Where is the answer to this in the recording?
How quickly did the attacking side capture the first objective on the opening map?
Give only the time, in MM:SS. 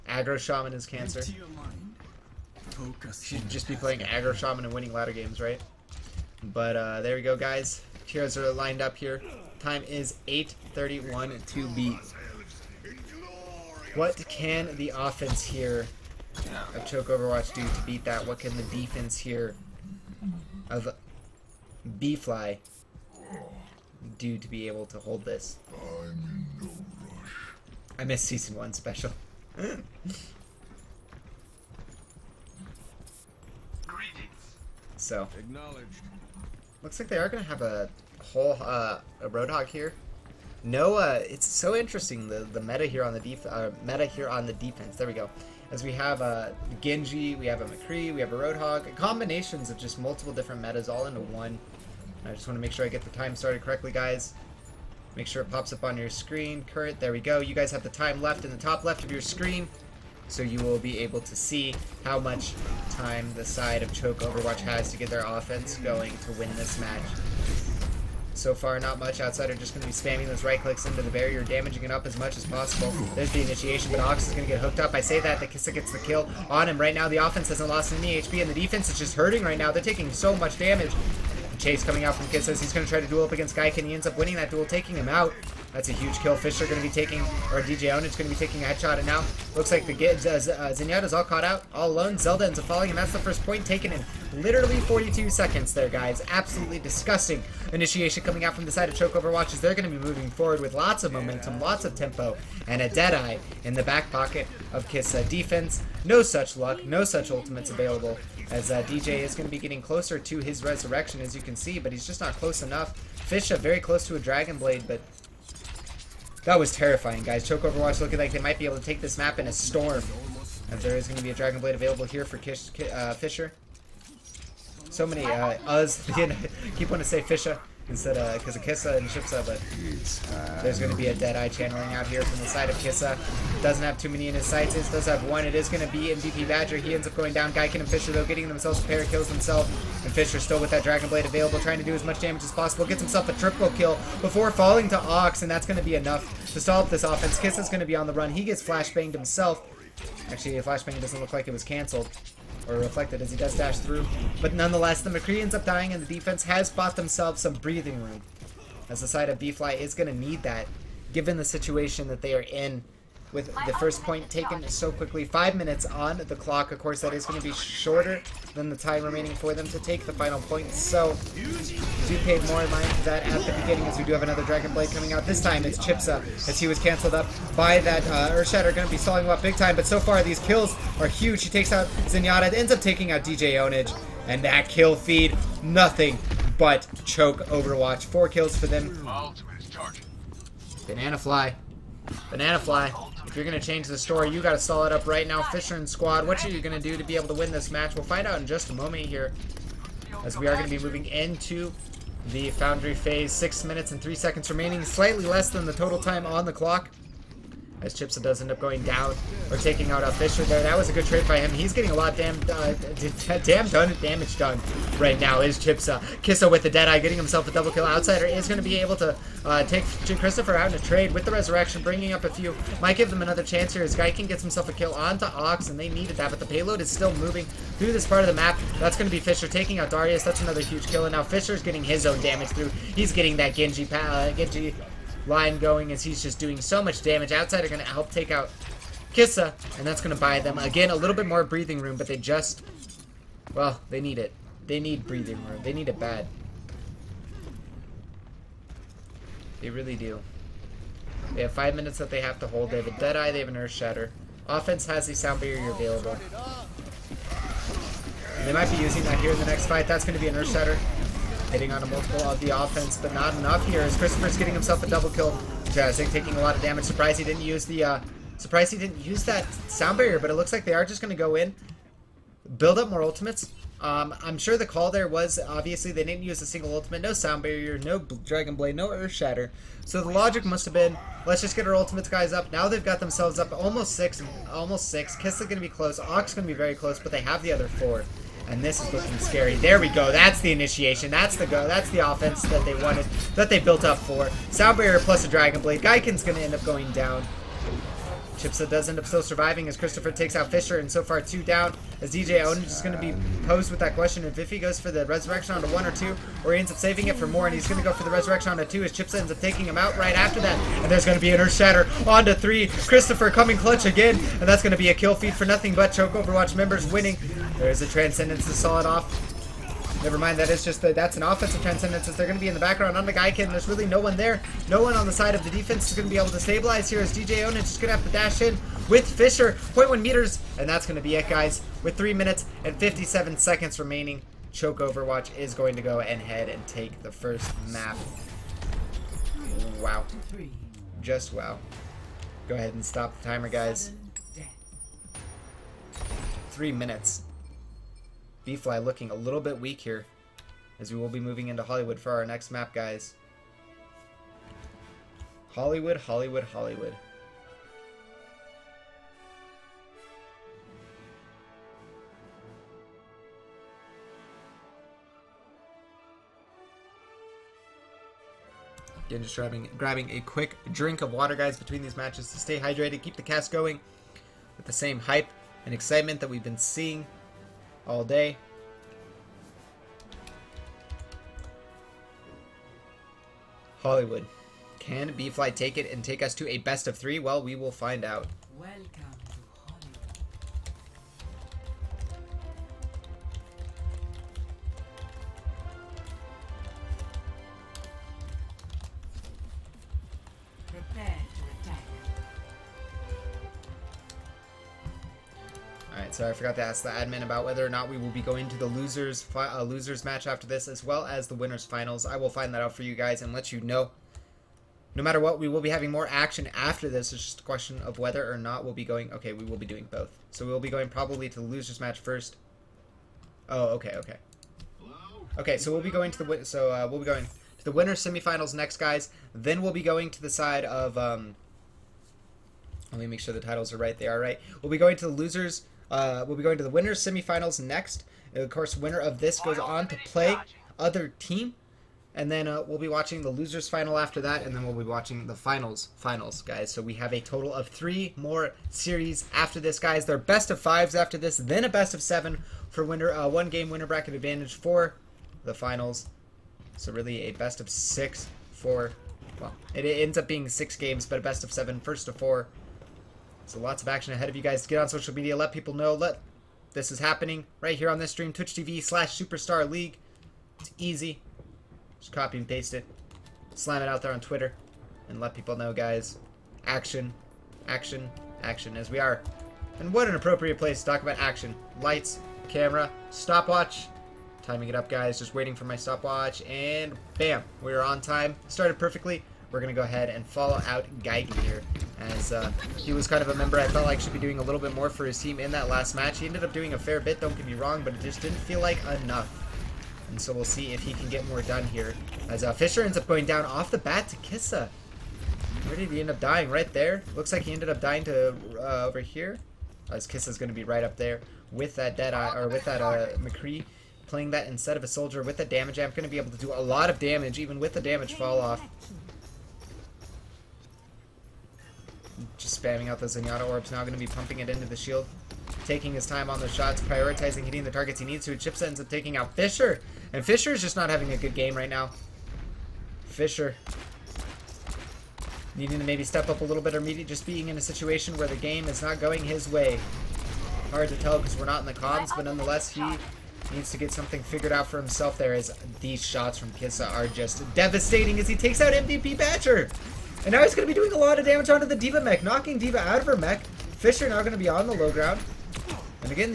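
01:34.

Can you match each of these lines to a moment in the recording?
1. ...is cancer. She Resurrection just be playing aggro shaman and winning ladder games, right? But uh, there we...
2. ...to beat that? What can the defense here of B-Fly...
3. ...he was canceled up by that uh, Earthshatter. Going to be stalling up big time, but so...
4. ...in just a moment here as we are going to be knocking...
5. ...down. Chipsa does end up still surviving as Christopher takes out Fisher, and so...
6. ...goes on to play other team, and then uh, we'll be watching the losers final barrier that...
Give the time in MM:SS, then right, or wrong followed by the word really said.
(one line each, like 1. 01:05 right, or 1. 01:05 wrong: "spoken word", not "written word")
1. 00:00 wrong: "Should", not "Resurrection"
2. 00:17 right
3. 02:56 right
4. 03:18 wrong: "moving", not "knocking"
5. 04:56 right
6. 07:19 wrong: "after", not "barrier".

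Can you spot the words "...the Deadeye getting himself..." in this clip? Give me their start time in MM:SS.
03:36.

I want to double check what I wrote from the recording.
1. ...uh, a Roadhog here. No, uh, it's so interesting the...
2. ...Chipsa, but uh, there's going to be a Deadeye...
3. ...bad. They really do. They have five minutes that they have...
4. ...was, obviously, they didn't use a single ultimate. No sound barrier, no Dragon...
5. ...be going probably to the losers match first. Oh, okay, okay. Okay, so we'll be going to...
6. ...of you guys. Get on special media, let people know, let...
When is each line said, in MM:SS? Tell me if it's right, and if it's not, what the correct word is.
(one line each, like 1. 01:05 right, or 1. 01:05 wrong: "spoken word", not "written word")
1. 00:38 right
2. 02:09 right
3. 04:05 right
4. 04:35 right
5. 07:00 right
6. 07:44 wrong: "social", not "special".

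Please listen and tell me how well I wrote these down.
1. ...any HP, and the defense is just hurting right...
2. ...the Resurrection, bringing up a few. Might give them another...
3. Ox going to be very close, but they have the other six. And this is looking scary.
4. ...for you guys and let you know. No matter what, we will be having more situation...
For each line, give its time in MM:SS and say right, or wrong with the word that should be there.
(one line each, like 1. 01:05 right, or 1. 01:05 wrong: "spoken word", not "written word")
1. 01:17 right
2. 03:41 right
3. 04:45 wrong: "four", not "six"
4. 06:52 wrong: "action", not "situation".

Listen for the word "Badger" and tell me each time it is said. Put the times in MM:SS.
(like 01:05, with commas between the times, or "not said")
02:16, 09:09.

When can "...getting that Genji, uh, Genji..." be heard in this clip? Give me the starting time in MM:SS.
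03:53.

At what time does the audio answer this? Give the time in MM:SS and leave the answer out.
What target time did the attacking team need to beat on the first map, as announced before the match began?
00:10.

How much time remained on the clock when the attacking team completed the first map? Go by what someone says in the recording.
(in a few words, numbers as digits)
3 minutes 57 seconds.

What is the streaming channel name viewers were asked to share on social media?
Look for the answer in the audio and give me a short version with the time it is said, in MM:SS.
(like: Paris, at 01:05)
Superstar League, at 07:49.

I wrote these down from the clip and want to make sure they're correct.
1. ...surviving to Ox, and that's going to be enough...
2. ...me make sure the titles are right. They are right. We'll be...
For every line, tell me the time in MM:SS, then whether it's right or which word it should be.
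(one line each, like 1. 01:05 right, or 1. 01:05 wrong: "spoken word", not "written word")
1. 02:24 wrong: "falling", not "surviving"
2. 07:13 right.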